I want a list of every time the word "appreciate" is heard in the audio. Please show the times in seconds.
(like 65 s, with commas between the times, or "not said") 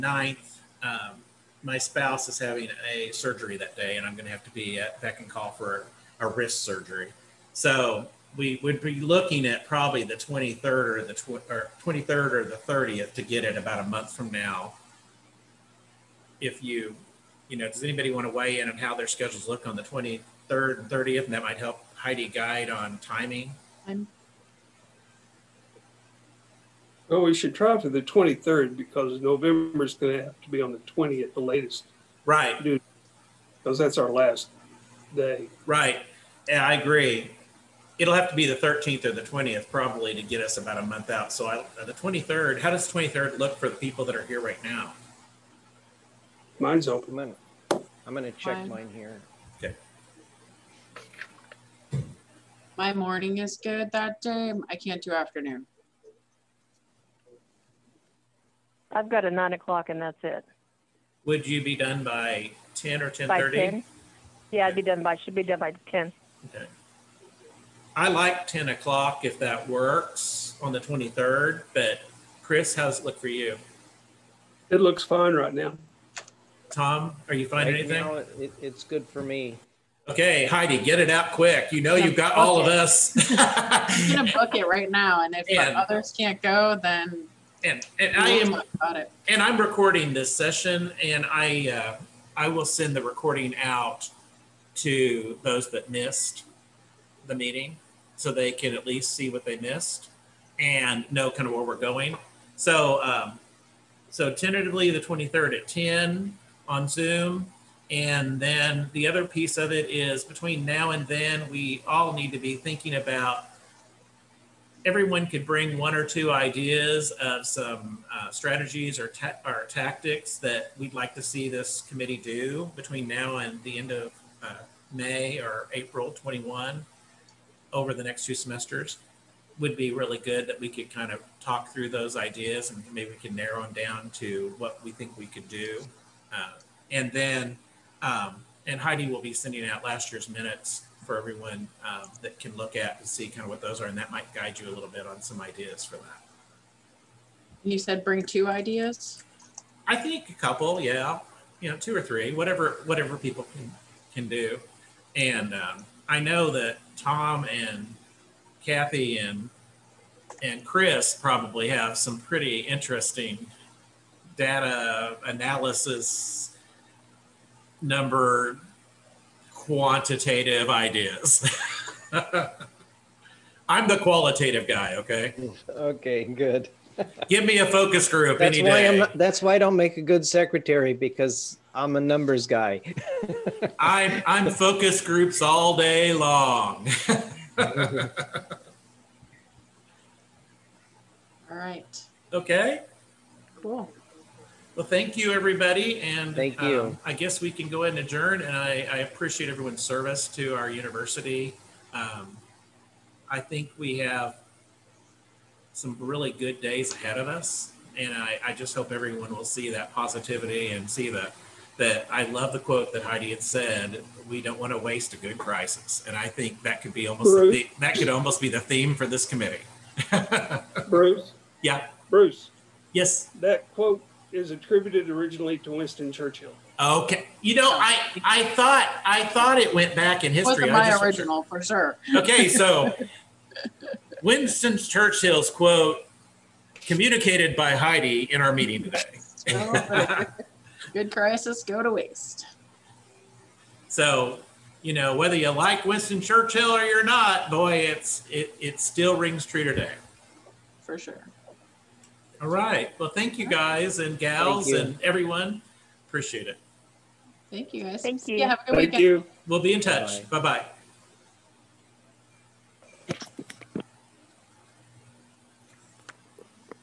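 198 s, 256 s.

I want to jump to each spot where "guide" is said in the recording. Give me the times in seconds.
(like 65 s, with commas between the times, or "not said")
22 s, 144 s.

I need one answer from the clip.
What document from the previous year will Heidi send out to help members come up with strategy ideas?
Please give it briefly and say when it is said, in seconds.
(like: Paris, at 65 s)
Last year's minutes, at 139 s.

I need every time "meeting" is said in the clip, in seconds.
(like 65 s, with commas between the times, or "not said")
97 s, 238 s.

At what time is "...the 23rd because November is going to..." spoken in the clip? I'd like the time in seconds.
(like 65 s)
27 s.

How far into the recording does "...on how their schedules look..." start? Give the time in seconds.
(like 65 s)
18 s.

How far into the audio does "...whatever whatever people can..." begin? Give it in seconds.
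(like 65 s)
152 s.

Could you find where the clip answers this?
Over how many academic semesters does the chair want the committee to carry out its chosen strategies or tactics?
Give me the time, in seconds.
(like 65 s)
128 s.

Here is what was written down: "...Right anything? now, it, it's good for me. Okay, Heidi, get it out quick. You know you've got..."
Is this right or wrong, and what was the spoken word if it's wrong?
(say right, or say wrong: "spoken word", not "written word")
right.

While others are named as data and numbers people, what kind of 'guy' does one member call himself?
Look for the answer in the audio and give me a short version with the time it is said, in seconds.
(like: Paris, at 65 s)
The qualitative guy, at 173 s.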